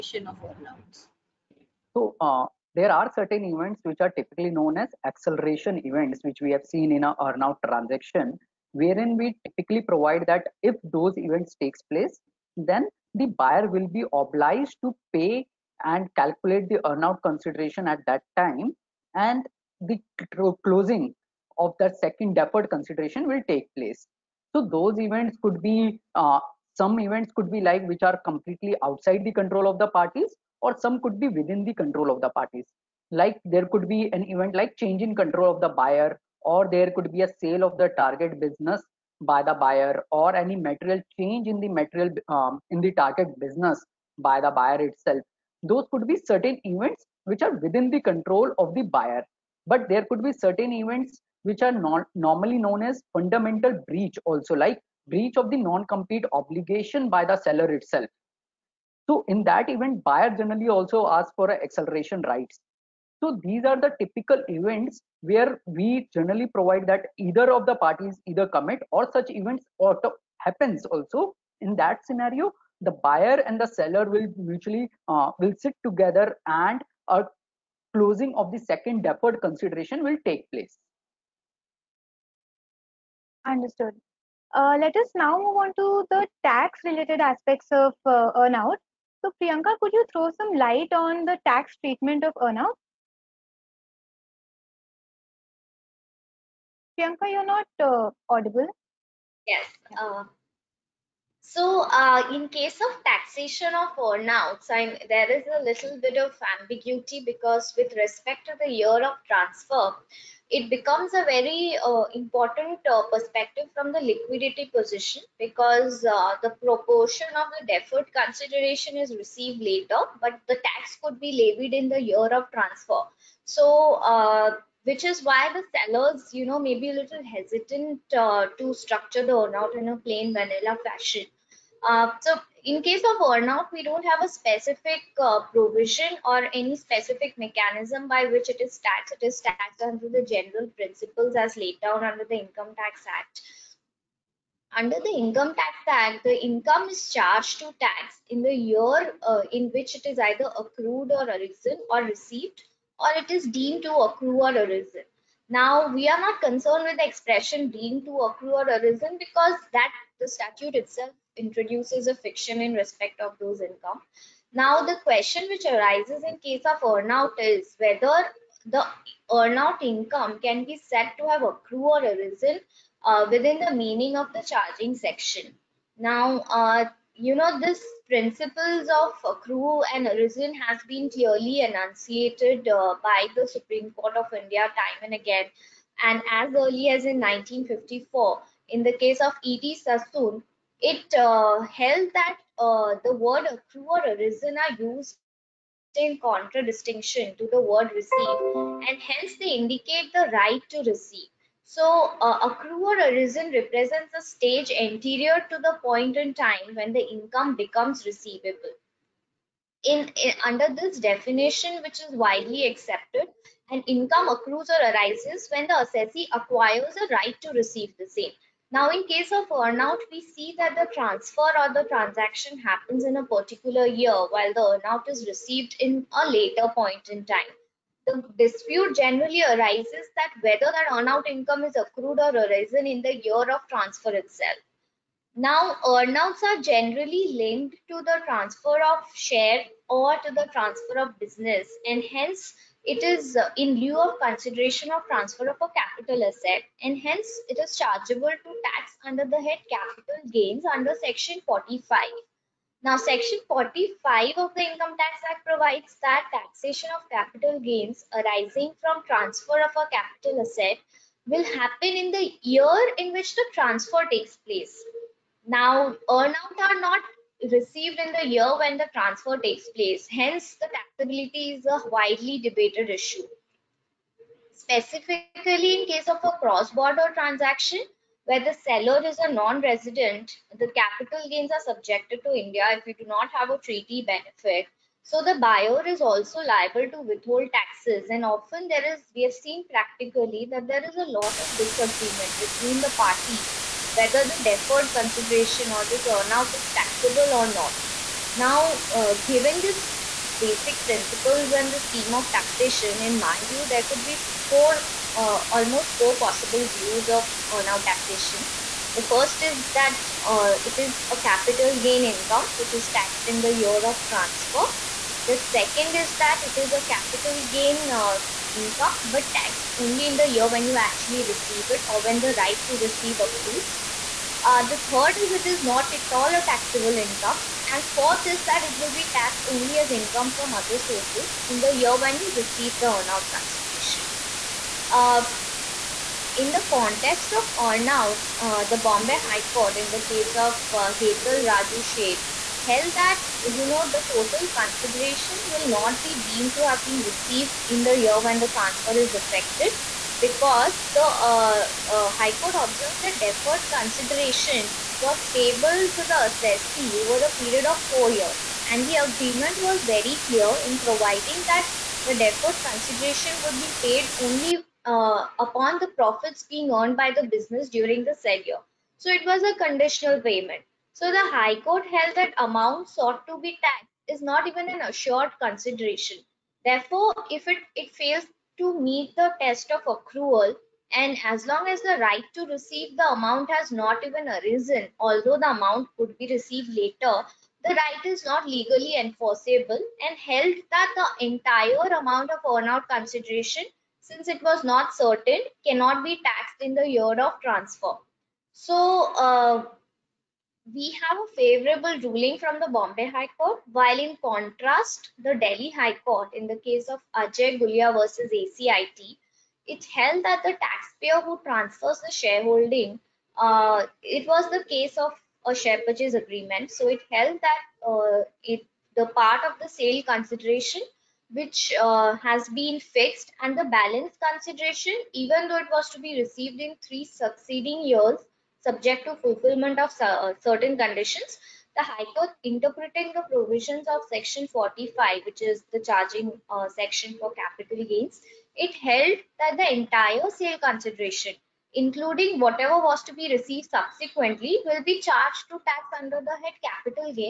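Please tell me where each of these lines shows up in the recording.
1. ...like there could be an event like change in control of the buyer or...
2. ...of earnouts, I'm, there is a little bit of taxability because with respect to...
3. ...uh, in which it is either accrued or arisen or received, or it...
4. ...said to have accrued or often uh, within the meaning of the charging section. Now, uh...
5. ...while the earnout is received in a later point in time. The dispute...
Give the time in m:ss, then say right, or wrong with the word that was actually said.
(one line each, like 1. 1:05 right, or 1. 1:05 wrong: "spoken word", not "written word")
1. 0:33 right
2. 1:43 wrong: "ambiguity", not "taxability"
3. 2:29 right
4. 2:50 wrong: "arisen", not "often"
5. 3:44 right.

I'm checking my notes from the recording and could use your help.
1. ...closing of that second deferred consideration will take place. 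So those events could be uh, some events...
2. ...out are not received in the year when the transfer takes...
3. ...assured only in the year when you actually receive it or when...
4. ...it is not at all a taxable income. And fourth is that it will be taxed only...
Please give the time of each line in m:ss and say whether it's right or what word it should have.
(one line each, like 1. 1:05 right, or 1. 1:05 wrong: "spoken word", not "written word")
1. 0:20 right
2. 4:26 right
3. 5:19 wrong: "taxed", not "assured"
4. 5:25 right.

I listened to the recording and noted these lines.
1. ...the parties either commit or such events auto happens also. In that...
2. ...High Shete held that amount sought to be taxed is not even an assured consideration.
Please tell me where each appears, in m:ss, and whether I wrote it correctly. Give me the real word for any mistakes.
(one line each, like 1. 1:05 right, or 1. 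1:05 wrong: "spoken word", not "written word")
1. 1:07 right
2. 6:11 wrong: "Court", not "Shete".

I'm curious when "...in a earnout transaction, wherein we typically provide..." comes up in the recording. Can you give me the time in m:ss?
0:06.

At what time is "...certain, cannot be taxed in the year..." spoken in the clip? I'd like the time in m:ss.
6:34.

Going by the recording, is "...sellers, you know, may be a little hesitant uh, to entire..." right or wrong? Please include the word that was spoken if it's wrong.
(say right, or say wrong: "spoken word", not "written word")
wrong: "structure", not "entire".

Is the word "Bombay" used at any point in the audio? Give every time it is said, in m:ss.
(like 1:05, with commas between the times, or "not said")
5:38, 6:42.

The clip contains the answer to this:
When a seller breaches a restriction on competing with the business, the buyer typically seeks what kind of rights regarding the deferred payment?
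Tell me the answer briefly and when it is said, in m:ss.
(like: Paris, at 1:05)
acceleration rights, at 1:01.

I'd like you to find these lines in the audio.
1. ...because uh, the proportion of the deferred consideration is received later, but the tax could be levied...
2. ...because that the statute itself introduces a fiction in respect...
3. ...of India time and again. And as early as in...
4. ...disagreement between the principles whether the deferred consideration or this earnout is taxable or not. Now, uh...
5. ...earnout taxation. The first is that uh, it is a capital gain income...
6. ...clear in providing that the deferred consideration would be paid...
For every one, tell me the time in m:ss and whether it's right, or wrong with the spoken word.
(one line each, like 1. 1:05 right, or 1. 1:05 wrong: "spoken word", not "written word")
1. 1:55 right
2. 2:39 right
3. 3:04 right
4. 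4:51 wrong: "parties", not "principles"
5. 5:07 right
6. 6:00 right.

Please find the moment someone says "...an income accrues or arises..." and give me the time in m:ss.
3:33.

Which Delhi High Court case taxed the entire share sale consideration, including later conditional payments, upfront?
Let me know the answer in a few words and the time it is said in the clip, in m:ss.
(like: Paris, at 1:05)
Ajay Gulia versus ACIT, at 6:47.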